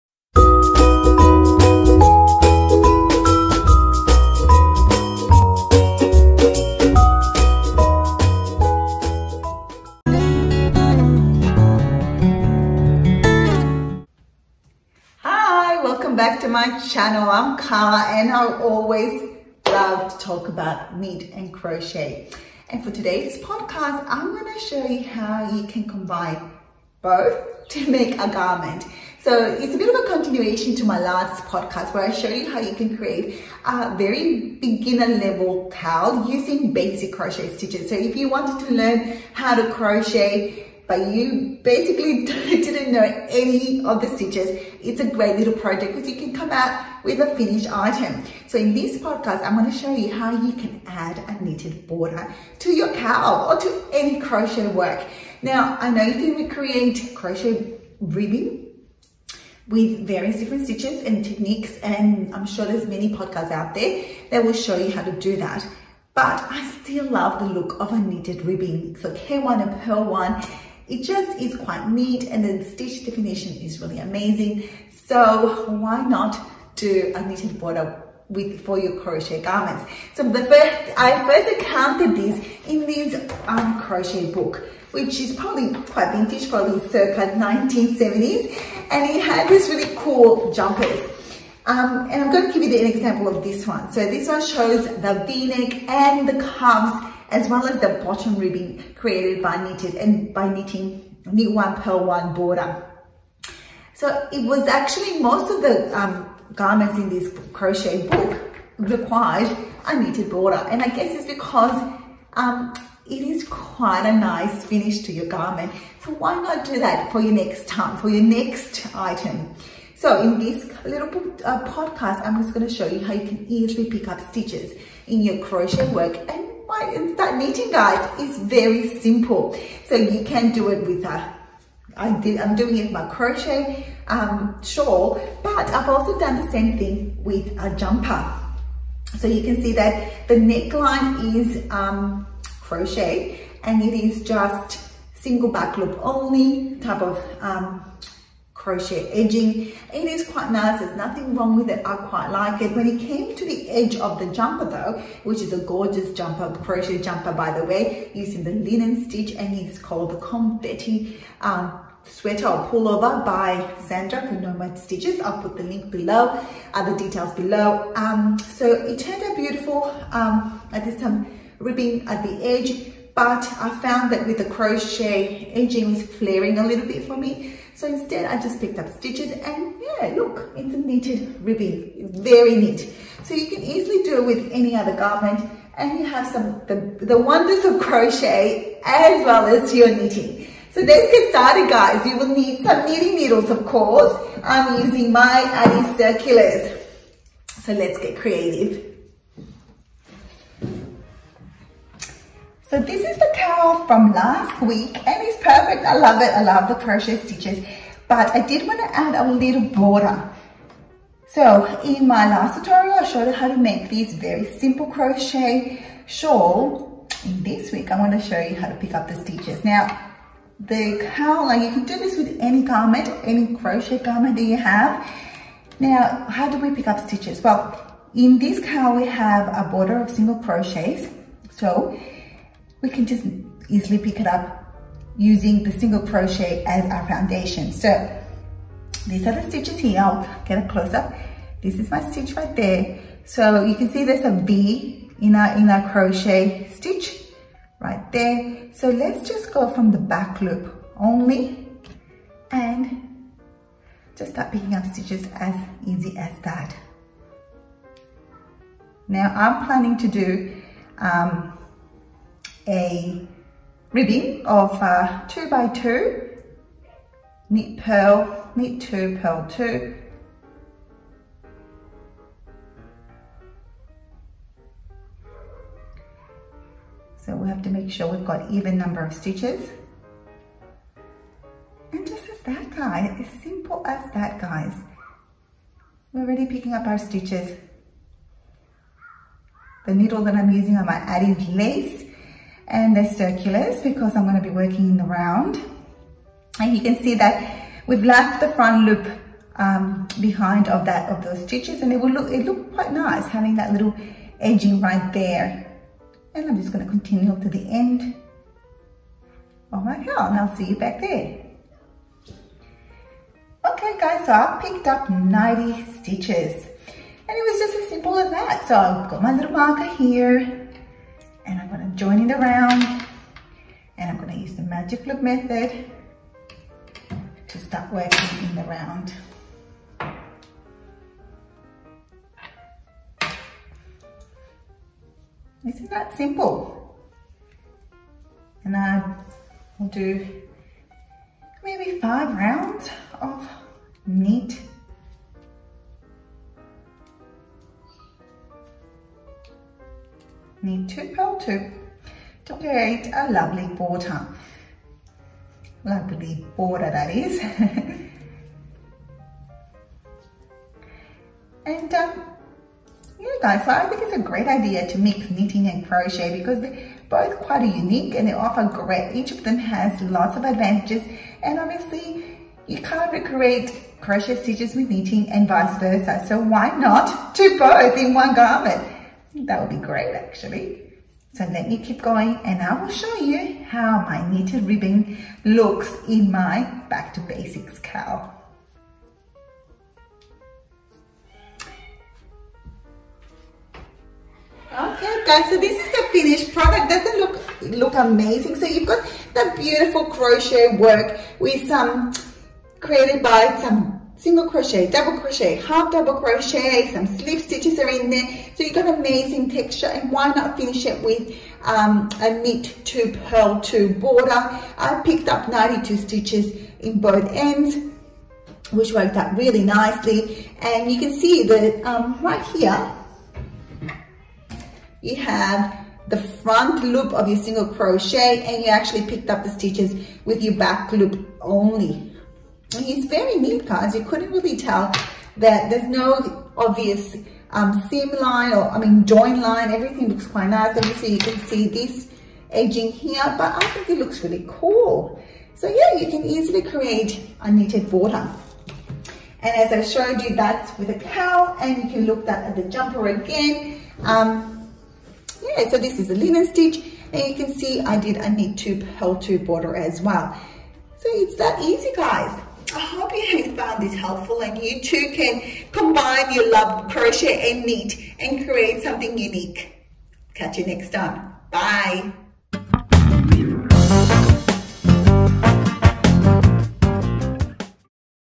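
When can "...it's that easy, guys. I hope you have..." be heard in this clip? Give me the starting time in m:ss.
7:41.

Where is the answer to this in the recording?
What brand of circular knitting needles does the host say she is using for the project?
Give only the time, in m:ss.
3:15.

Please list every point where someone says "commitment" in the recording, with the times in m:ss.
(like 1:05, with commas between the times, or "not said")
not said.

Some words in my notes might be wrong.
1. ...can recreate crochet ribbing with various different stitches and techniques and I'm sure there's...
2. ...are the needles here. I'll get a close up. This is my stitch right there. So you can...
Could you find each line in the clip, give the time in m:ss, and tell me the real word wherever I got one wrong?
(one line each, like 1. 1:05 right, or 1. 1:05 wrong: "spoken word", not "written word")
1. 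0:56 wrong: "create", not "recreate"
2. 3:59 wrong: "stitches", not "needles".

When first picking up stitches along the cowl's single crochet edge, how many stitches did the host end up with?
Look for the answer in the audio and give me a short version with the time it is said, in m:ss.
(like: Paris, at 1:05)
90, at 5:15.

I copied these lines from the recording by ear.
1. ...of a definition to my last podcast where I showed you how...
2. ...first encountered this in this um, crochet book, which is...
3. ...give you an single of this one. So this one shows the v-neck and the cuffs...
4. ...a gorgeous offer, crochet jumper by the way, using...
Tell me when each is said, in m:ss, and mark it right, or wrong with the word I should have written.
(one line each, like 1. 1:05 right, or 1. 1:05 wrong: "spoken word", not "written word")
1. 0:29 wrong: "continuation", not "definition"
2. 1:21 right
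3. 1:32 wrong: "example", not "single"
4. 2:35 wrong: "jumper", not "offer".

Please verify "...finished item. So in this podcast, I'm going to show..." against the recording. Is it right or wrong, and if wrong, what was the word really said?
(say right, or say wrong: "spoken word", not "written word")
right.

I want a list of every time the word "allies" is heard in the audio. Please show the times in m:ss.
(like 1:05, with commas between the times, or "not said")
not said.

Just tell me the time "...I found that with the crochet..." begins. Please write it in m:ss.
2:53.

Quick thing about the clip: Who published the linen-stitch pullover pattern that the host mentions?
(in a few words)
Nomad Stitches.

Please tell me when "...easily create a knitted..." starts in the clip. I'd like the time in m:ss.
7:26.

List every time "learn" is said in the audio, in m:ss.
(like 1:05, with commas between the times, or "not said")
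0:38.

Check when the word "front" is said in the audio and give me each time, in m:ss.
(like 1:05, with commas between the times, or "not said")
4:58, 7:06.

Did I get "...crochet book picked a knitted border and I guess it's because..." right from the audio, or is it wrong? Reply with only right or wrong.
wrong.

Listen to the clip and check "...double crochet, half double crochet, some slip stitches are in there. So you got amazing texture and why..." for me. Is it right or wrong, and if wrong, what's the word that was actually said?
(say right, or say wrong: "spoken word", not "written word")
right.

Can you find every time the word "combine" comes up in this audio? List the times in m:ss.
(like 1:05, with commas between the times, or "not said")
0:25, 7:45.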